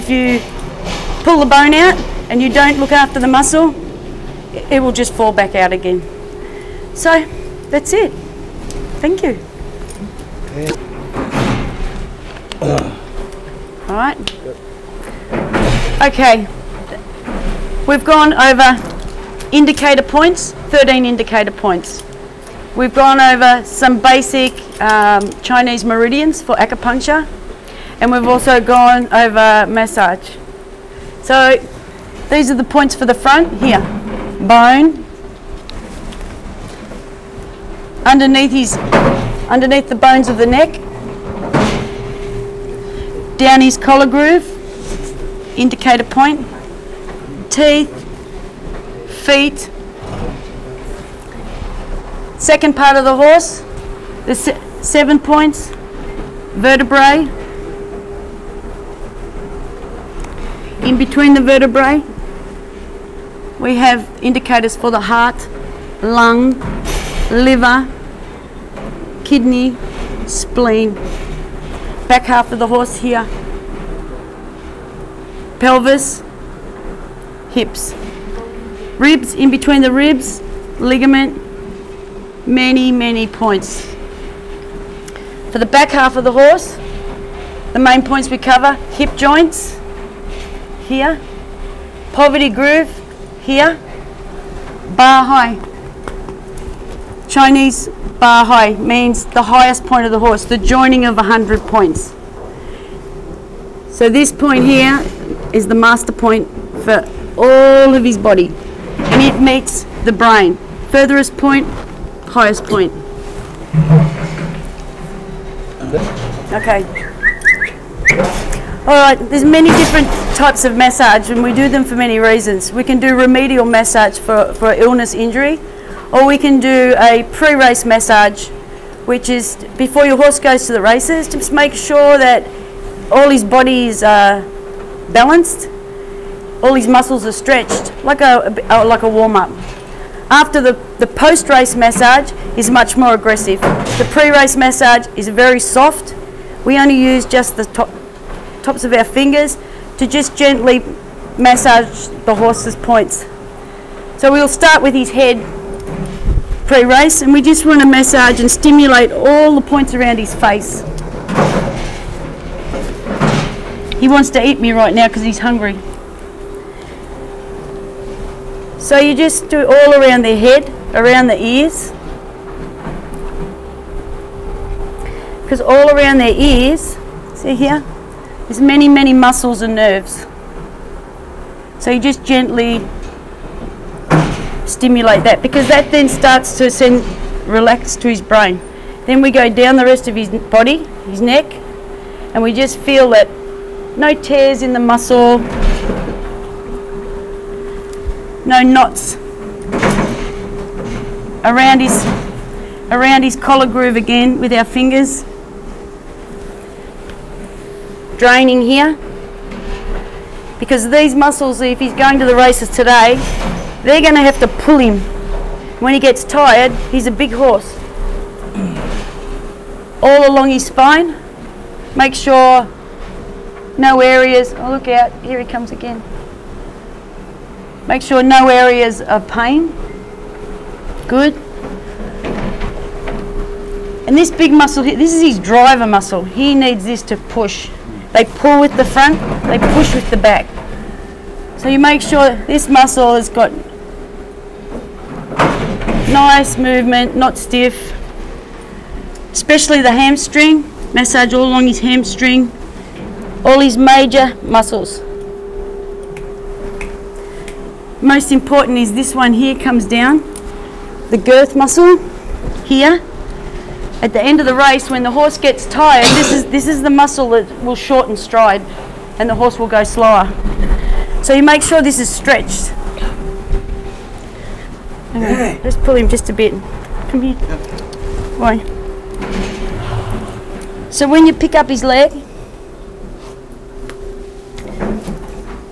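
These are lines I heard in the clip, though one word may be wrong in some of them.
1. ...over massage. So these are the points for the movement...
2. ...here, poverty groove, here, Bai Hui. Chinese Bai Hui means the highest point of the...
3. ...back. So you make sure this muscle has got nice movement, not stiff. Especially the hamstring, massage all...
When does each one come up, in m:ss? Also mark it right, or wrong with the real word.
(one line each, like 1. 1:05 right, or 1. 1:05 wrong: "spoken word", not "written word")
1. 0:29 wrong: "front", not "movement"
2. 1:30 right
3. 4:00 right.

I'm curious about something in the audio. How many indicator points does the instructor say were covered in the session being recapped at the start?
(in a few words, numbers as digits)
13.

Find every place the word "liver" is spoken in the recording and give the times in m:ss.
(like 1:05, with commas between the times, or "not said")
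1:07.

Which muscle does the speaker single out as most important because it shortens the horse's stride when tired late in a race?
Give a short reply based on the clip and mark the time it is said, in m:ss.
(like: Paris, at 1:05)
girth muscle, at 4:21.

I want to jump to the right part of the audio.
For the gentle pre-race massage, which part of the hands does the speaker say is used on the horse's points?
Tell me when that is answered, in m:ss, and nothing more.
2:28.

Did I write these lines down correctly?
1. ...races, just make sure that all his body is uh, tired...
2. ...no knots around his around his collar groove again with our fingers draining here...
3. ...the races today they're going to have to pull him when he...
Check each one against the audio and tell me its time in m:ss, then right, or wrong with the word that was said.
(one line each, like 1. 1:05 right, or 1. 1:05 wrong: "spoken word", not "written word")
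1. 2:10 wrong: "balanced", not "tired"
2. 3:18 right
3. 3:32 right.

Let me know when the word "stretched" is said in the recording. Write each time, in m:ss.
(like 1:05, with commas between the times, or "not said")
2:17, 4:32.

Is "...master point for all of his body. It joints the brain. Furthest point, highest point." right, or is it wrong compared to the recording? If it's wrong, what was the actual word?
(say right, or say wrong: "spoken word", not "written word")
wrong: "meets", not "joints".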